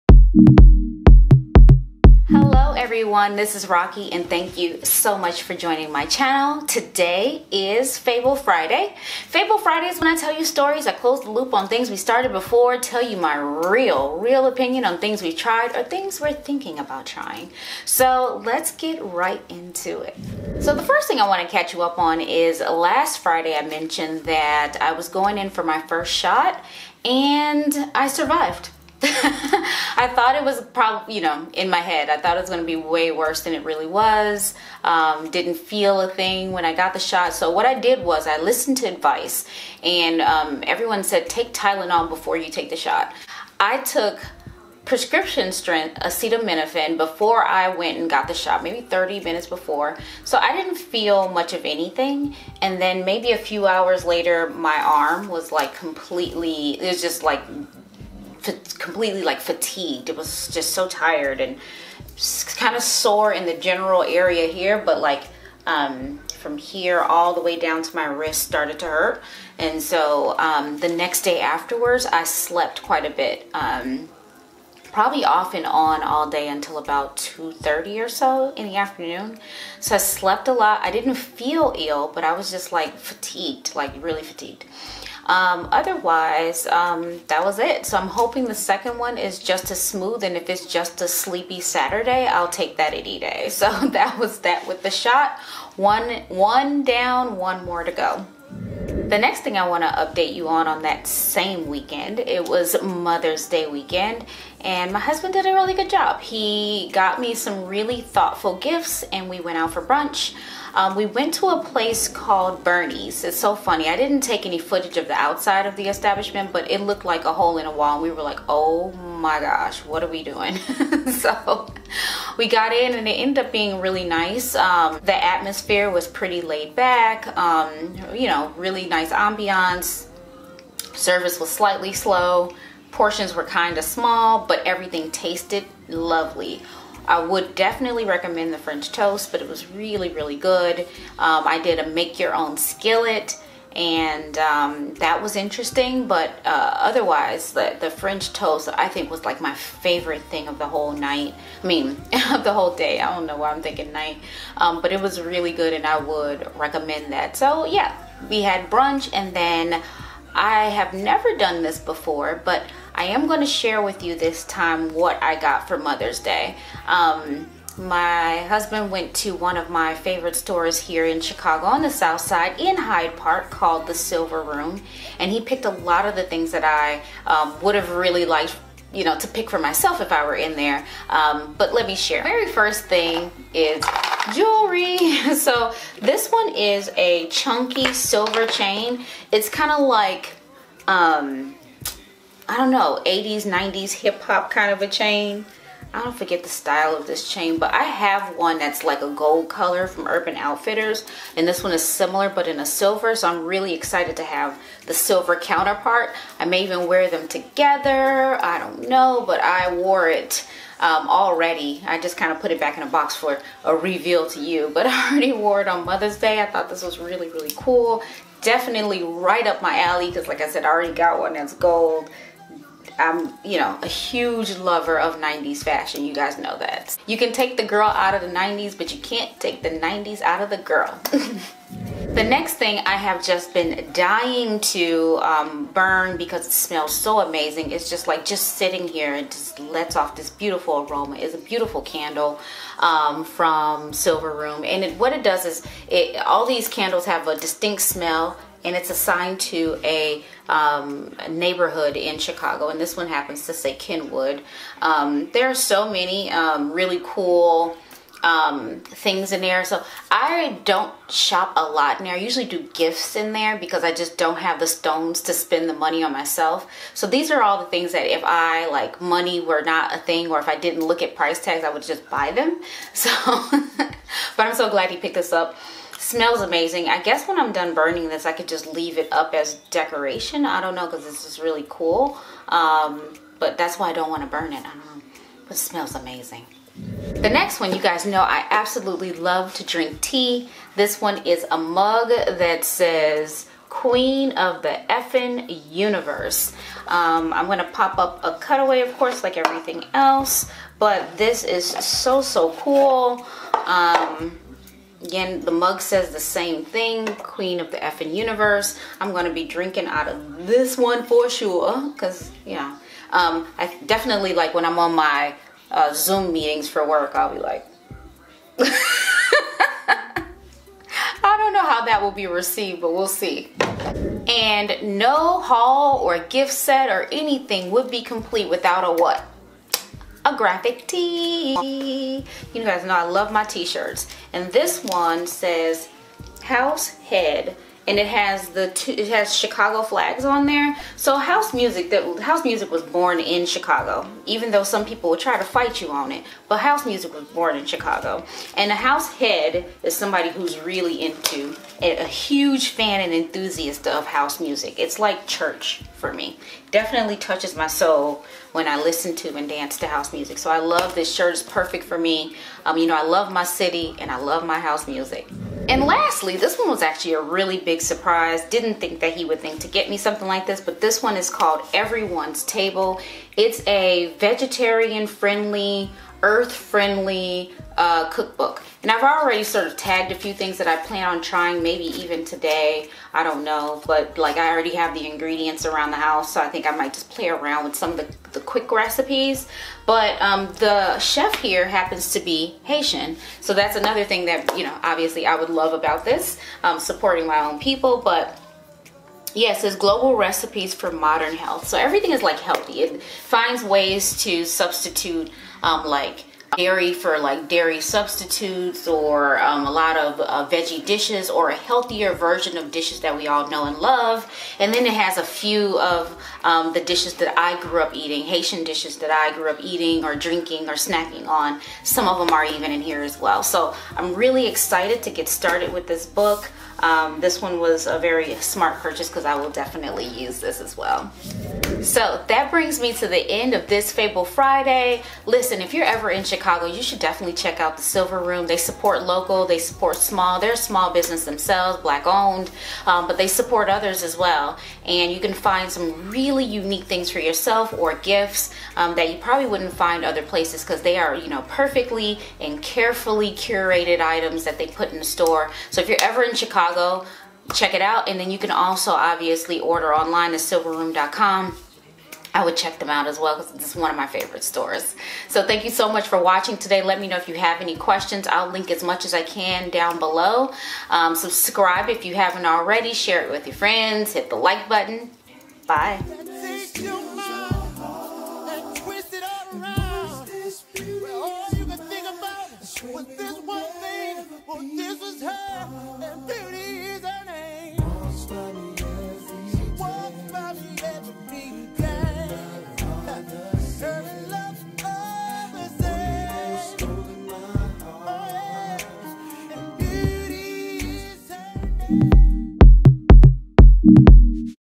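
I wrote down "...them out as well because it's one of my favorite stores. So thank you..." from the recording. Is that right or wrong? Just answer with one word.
right.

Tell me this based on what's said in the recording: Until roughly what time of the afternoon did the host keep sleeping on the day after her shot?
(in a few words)
2:30.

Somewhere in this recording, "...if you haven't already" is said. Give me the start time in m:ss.
7:51.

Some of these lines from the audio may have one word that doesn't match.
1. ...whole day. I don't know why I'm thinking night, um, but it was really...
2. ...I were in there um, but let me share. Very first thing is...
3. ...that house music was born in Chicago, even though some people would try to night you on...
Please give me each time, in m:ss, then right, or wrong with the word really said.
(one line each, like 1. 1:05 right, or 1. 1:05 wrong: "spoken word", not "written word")
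1. 2:32 right
2. 3:00 right
3. 5:41 wrong: "fight", not "night".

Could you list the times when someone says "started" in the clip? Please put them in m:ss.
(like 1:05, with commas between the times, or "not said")
0:11, 1:08, 7:05.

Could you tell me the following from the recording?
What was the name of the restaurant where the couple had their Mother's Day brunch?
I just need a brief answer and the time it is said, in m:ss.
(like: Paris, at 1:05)
Bernie's, at 1:52.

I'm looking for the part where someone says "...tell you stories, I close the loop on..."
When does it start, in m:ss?
0:10.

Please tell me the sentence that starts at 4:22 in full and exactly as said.
I usually do gifts in there because I just don't have the stones to spend the money on myself.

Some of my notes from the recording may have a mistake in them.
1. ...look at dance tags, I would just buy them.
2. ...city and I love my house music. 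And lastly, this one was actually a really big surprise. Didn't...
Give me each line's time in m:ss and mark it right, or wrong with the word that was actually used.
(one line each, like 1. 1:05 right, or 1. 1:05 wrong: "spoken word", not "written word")
1. 4:30 wrong: "price", not "dance"
2. 6:03 right.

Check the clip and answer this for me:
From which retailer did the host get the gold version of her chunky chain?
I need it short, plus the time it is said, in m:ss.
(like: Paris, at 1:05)
Urban Outfitters, at 3:20.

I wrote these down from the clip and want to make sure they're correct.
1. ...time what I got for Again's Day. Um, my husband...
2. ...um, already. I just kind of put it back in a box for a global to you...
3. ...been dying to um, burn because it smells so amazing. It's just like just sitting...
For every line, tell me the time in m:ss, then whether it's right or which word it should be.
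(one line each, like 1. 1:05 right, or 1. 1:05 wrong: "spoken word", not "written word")
1. 2:44 wrong: "Mother", not "Again"
2. 3:30 wrong: "reveal", not "global"
3. 3:53 right.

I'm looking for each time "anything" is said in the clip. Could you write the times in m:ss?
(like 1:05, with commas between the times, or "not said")
0:51, 5:27.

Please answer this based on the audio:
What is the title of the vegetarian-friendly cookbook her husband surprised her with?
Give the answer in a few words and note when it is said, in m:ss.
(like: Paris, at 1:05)
Everyone's Table, at 6:11.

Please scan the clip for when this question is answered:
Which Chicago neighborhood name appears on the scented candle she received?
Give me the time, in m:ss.
4:13.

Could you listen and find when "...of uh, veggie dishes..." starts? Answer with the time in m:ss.
6:49.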